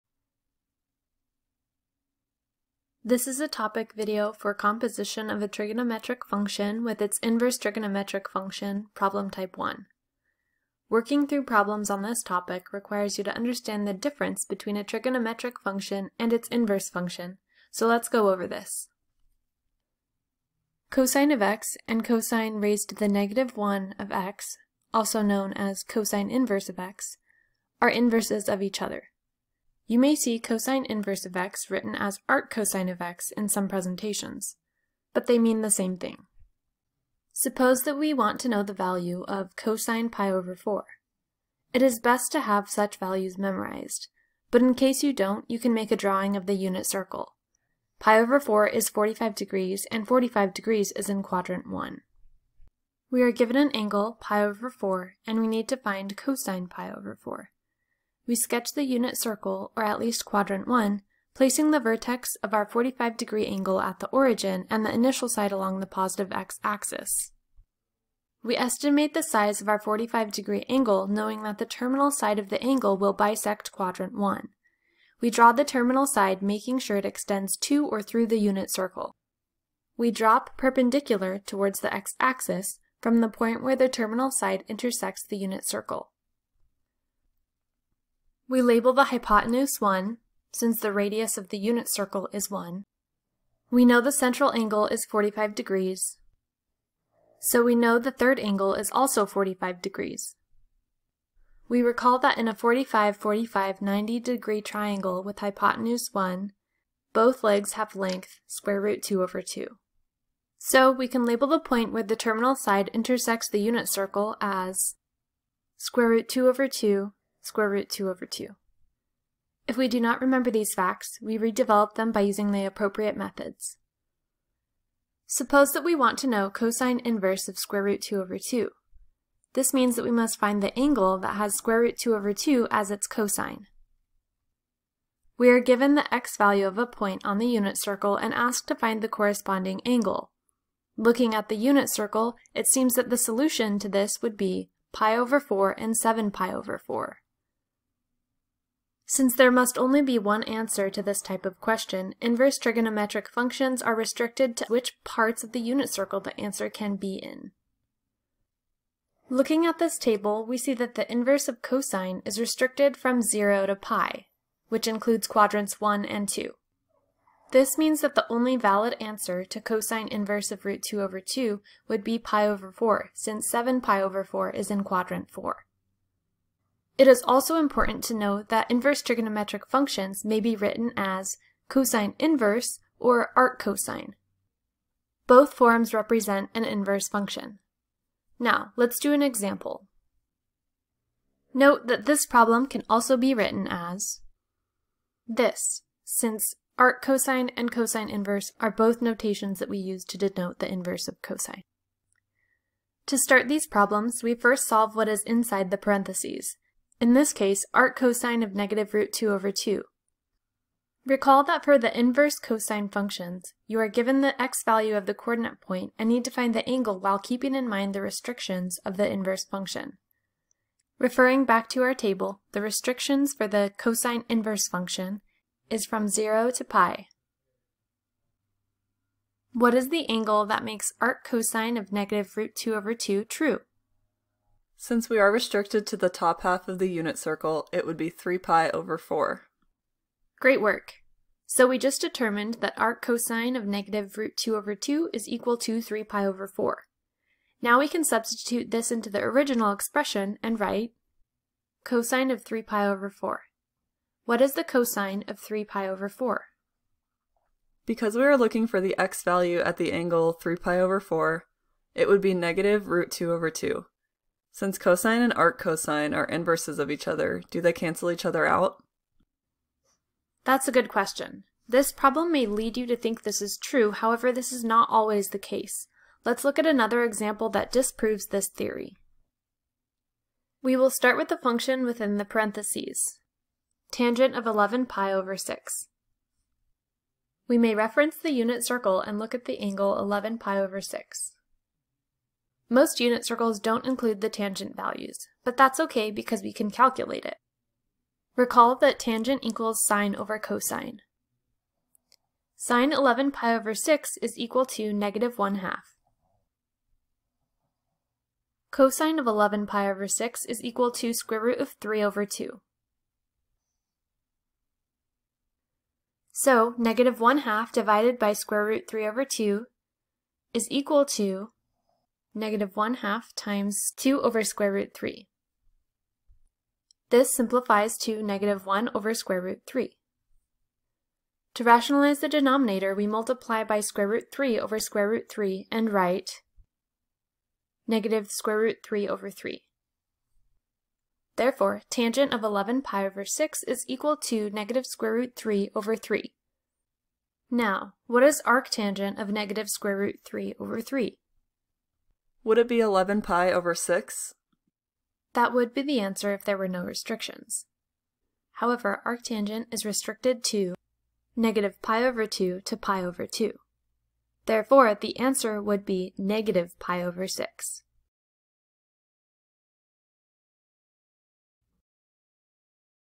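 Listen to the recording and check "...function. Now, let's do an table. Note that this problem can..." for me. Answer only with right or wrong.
wrong.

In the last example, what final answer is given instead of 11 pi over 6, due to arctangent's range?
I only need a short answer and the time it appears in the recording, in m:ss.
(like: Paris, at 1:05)
-pi/6, at 6:06.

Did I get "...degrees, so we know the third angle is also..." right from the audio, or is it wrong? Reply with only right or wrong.
right.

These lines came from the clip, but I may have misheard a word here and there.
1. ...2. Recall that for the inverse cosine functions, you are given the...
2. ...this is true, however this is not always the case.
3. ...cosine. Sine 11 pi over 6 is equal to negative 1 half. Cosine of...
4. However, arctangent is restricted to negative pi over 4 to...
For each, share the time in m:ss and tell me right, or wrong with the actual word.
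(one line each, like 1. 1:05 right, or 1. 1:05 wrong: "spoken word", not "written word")
1. 3:29 right
2. 4:33 right
3. 5:00 right
4. 5:58 wrong: "2", not "4".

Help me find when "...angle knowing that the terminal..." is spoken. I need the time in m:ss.
1:10.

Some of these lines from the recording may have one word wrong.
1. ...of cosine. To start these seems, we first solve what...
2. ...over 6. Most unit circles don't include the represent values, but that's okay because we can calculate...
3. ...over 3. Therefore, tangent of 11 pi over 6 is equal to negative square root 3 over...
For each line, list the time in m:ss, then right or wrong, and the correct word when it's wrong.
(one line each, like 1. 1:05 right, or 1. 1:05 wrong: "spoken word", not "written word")
1. 3:21 wrong: "problems", not "seems"
2. 4:50 wrong: "tangent", not "represent"
3. 5:39 right.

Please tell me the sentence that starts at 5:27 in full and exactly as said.
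This simplifies to negative 1 over square root 3.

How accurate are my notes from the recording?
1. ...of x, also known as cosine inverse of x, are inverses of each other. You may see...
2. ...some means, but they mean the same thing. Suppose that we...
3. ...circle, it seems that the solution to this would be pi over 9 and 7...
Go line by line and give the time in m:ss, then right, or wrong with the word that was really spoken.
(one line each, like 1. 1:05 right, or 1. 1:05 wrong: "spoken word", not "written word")
1. 0:23 right
2. 0:33 wrong: "presentations", not "means"
3. 2:21 wrong: "4", not "9".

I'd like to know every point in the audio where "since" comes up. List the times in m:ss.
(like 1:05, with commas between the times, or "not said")
1:30, 2:29, 2:53, 3:16, 3:54, 4:24.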